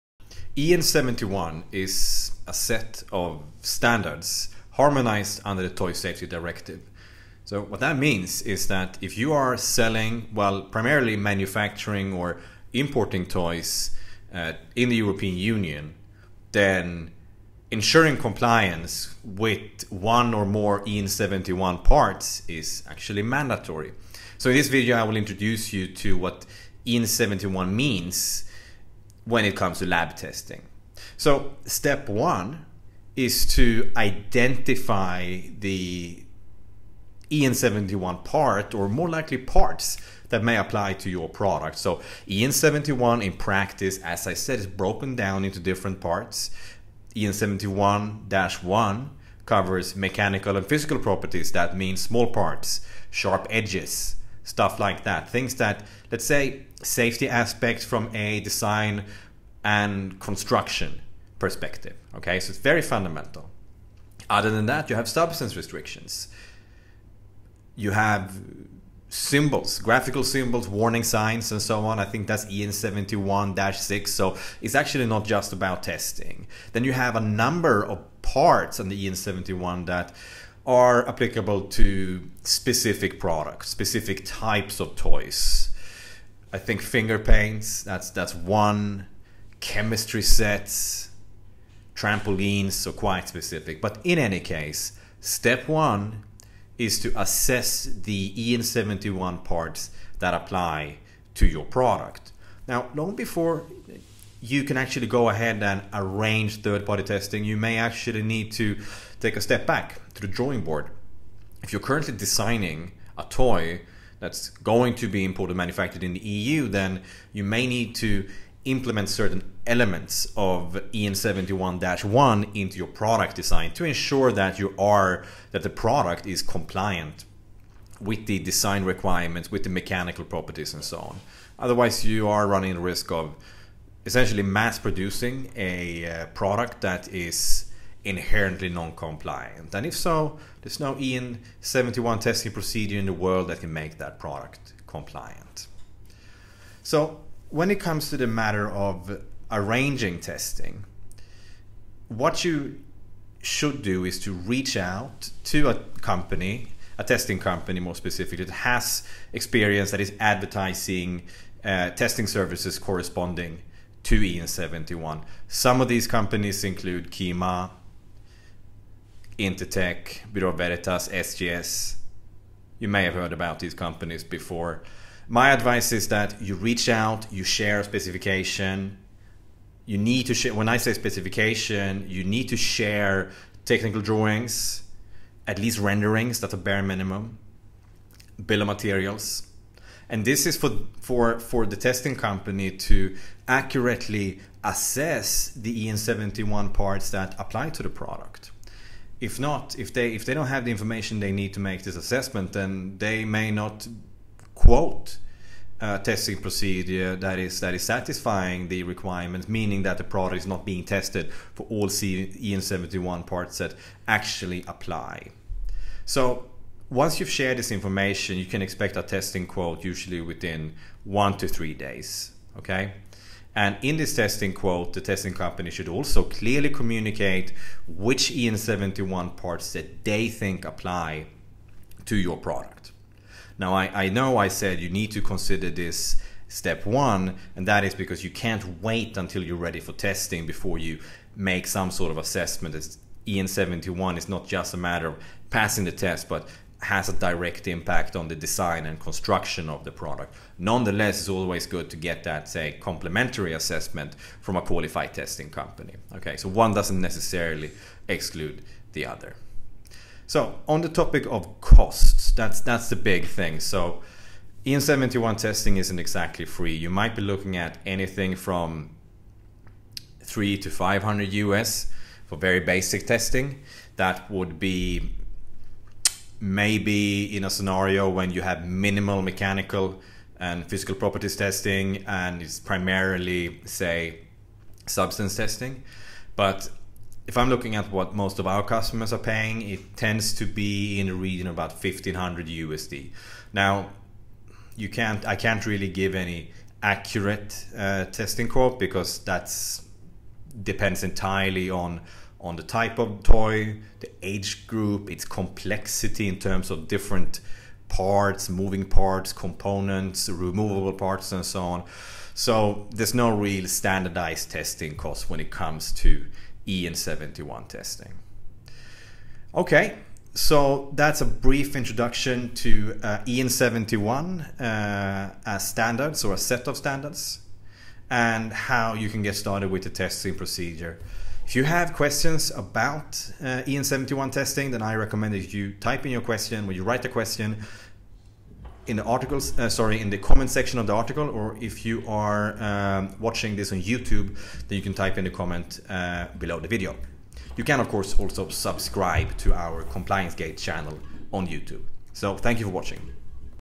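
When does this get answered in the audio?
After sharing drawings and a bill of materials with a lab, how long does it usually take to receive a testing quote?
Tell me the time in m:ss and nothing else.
3:41.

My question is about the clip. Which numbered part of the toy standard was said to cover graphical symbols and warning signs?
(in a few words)
EN 71-6.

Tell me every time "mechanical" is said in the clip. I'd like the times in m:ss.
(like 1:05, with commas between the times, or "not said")
0:49, 2:09, 4:39.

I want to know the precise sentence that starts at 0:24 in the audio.
So in this video, I will introduce you to what EN71 means when it comes to lab testing.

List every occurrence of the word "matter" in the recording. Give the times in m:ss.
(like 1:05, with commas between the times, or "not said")
2:28, 4:04.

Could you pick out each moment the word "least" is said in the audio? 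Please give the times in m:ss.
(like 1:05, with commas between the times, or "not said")
3:05.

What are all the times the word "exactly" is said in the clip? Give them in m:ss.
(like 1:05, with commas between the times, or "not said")
4:25.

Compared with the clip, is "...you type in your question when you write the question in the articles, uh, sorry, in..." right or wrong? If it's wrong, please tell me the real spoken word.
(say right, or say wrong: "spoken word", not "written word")
right.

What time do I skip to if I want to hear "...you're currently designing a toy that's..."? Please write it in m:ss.
1:51.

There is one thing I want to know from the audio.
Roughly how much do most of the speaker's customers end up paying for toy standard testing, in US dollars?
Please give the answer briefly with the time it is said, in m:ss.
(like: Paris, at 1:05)
$1,500, at 4:51.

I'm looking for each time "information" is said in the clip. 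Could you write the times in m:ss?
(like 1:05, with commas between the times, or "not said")
3:20, 3:37.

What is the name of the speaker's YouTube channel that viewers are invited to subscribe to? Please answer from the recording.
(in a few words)
Compliance Gate.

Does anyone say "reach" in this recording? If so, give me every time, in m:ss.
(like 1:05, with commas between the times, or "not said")
2:34, 2:56.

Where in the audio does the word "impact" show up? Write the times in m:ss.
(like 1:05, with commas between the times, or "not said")
4:07.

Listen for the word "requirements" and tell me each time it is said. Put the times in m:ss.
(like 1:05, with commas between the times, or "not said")
2:08, 3:28.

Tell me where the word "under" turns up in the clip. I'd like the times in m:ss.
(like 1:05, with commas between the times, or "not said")
0:05.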